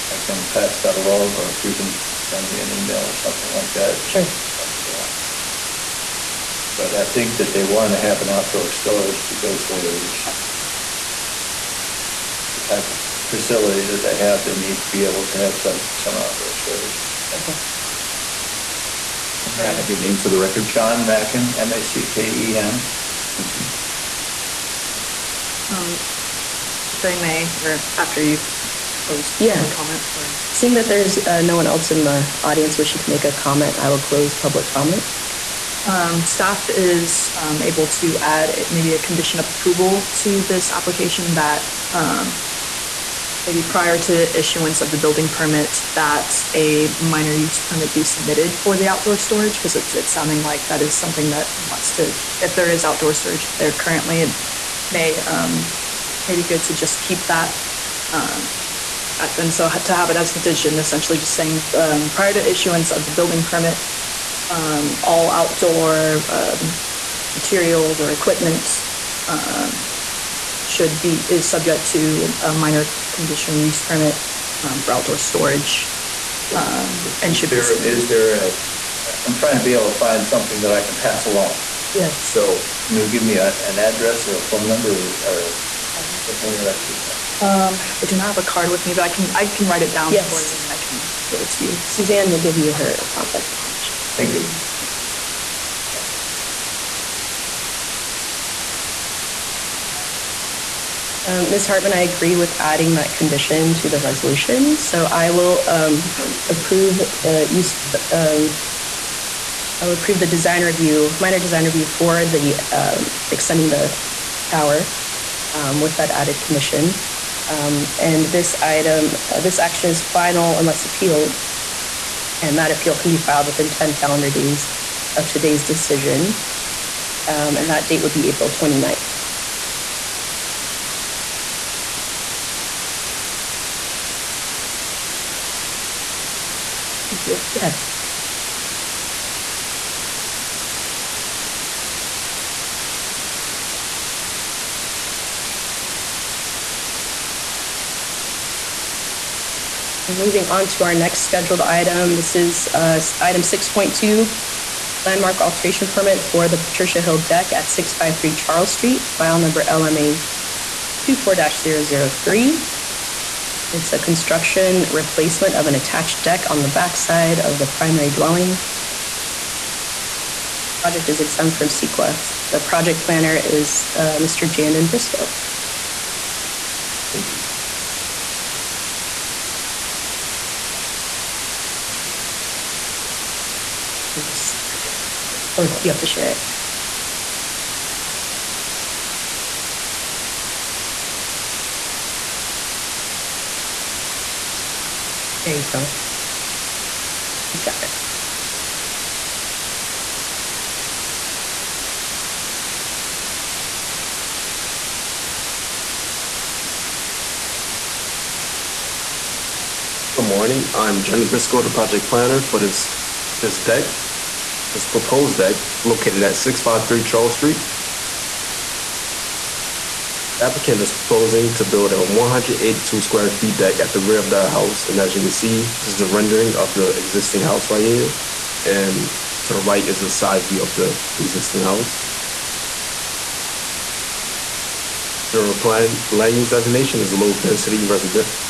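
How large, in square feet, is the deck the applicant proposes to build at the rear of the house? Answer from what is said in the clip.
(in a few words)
182.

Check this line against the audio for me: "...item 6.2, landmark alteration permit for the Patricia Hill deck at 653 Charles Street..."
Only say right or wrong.
right.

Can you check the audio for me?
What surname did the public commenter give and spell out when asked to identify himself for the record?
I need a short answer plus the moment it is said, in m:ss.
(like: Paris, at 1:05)
Macken, at 0:20.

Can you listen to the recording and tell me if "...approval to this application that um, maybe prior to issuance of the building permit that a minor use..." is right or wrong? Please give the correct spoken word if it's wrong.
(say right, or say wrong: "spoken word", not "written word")
right.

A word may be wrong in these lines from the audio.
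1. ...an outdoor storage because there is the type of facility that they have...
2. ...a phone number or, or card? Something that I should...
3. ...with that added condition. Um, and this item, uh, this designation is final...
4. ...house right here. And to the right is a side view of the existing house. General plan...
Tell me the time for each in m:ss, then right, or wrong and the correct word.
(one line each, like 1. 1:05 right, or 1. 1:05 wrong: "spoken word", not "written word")
1. 0:08 right
2. 1:24 right
3. 1:55 wrong: "action", not "designation"
4. 3:47 right.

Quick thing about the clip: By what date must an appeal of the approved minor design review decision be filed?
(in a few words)
April 29th.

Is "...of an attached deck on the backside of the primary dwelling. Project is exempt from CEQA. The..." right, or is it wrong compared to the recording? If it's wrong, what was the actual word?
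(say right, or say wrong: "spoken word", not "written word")
right.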